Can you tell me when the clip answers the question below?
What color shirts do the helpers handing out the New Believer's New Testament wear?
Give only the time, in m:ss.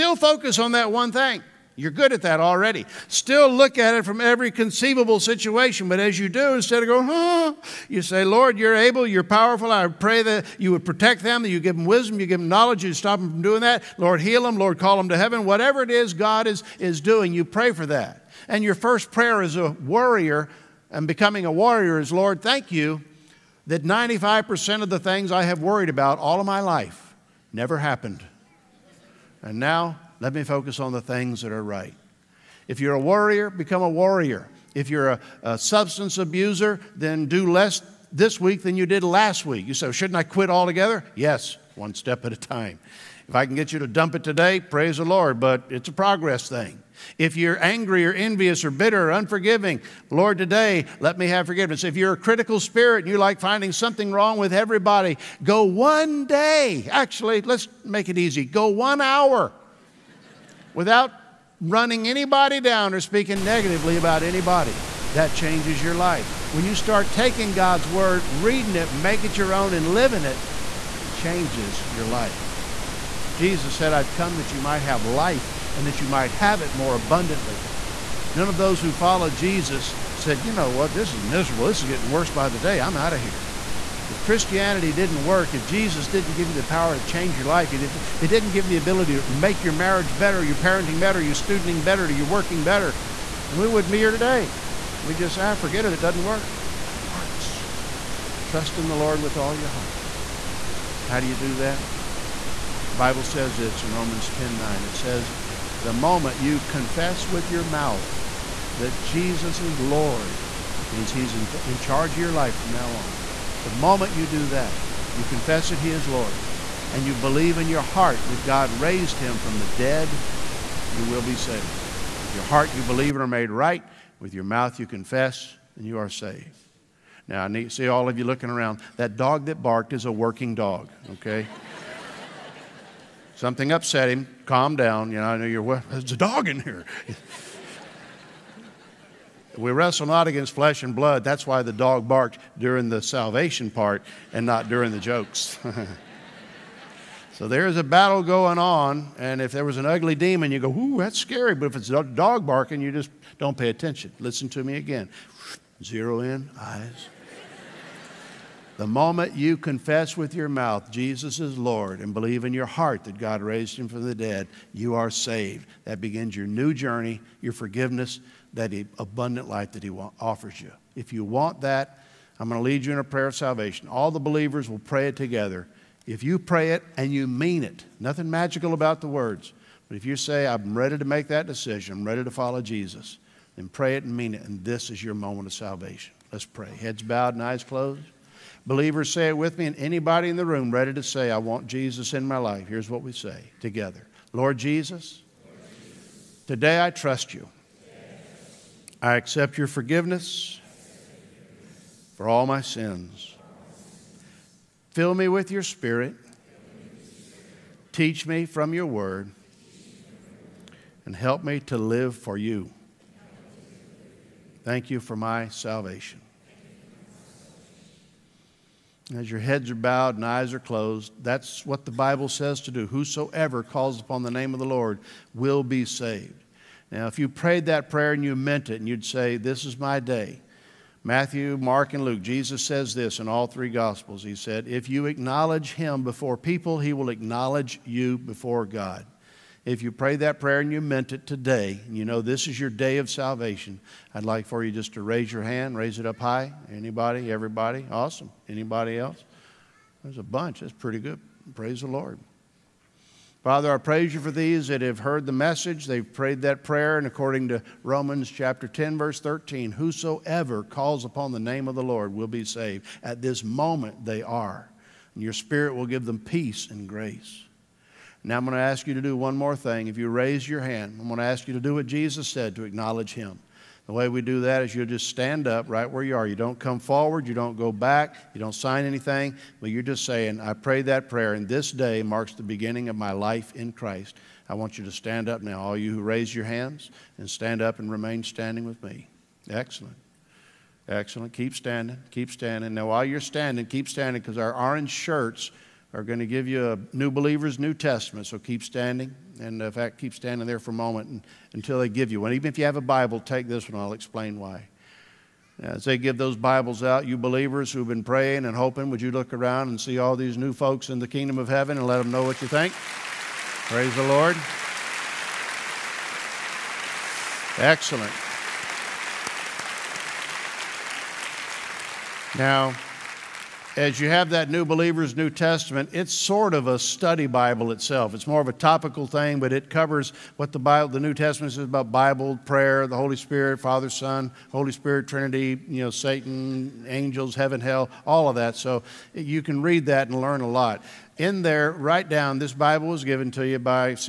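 4:54.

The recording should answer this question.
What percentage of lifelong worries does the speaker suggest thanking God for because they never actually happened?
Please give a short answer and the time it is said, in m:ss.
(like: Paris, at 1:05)
95%, at 0:23.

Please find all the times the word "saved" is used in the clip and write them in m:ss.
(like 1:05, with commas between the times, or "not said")
2:01, 2:06, 2:45, 3:45, 4:22.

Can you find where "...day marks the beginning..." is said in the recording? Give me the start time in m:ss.
4:41.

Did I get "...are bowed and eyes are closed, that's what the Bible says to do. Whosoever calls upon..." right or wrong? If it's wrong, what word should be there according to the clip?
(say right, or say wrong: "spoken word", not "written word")
right.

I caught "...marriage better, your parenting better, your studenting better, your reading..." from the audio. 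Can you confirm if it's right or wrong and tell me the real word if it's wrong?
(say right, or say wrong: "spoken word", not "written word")
wrong: "working", not "reading".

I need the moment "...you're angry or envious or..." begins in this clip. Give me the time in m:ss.
0:47.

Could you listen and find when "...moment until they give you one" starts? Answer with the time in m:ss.
5:00.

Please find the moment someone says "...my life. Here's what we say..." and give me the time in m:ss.
3:12.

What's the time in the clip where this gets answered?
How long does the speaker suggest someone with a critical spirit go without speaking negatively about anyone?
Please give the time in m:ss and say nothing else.
0:58.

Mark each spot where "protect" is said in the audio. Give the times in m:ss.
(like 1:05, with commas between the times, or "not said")
0:10.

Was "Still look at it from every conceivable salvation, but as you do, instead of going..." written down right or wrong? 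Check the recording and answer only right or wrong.
wrong.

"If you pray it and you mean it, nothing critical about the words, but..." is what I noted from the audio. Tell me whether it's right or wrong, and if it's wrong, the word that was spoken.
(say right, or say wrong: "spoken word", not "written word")
wrong: "magical", not "critical".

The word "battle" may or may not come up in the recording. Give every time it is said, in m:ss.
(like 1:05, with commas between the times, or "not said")
2:27.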